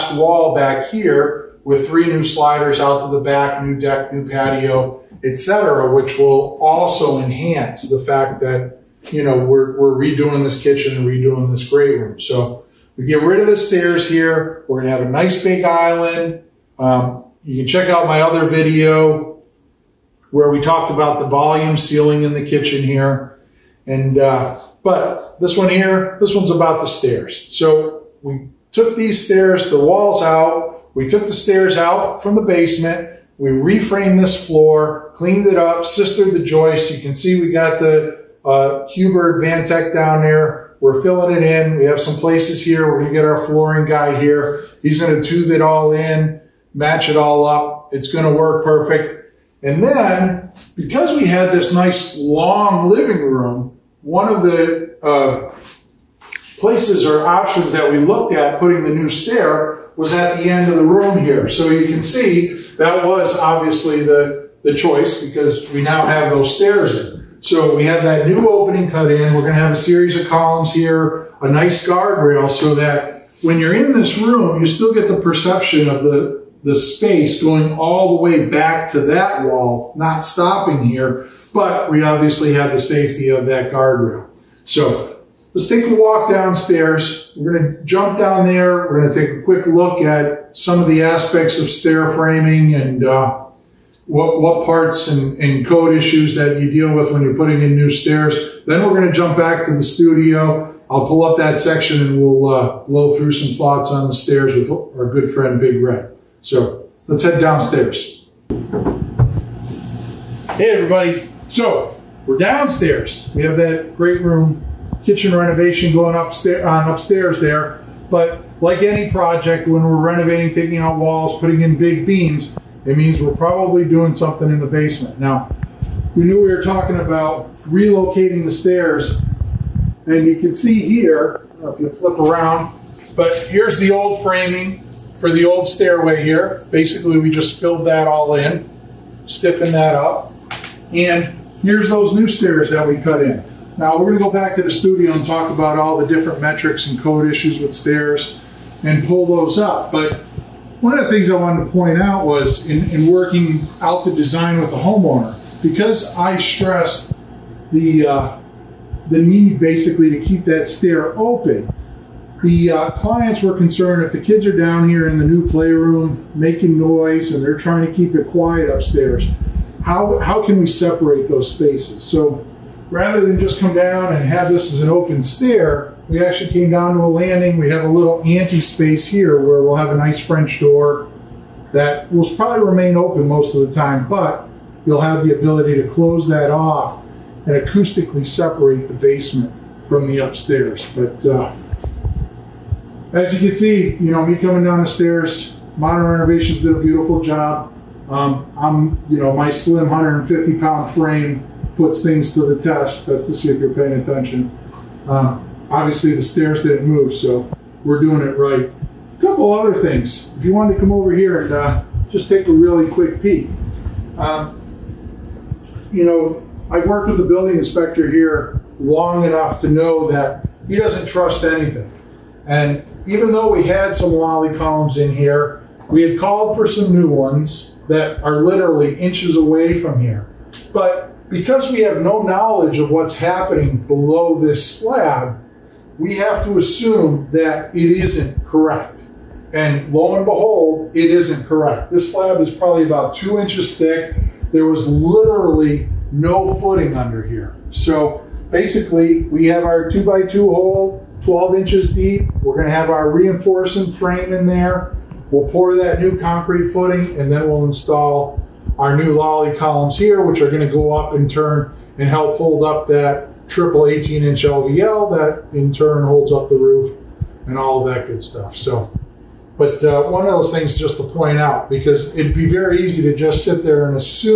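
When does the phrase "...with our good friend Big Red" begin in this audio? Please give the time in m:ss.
1:44.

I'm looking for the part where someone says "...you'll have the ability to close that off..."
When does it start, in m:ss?
3:04.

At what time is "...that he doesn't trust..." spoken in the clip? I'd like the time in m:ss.
3:40.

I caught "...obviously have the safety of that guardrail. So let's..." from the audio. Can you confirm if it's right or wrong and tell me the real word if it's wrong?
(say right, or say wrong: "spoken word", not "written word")
right.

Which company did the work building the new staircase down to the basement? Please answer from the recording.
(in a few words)
Modern Renovations.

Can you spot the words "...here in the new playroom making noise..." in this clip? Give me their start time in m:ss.
2:44.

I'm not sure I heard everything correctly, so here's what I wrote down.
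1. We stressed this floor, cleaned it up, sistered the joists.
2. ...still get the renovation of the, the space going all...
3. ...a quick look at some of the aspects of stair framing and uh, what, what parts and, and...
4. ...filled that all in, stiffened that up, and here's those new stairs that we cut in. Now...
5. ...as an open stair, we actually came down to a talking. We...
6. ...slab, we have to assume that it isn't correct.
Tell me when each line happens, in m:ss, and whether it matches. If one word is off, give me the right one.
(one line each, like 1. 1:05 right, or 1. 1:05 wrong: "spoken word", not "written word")
1. 0:33 wrong: "reframed", not "stressed"
2. 1:14 wrong: "perception", not "renovation"
3. 1:29 right
4. 2:17 right
5. 2:54 wrong: "landing", not "talking"
6. 3:54 right.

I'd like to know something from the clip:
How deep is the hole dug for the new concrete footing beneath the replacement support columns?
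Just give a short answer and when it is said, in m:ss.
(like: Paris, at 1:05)
12 inches, at 4:11.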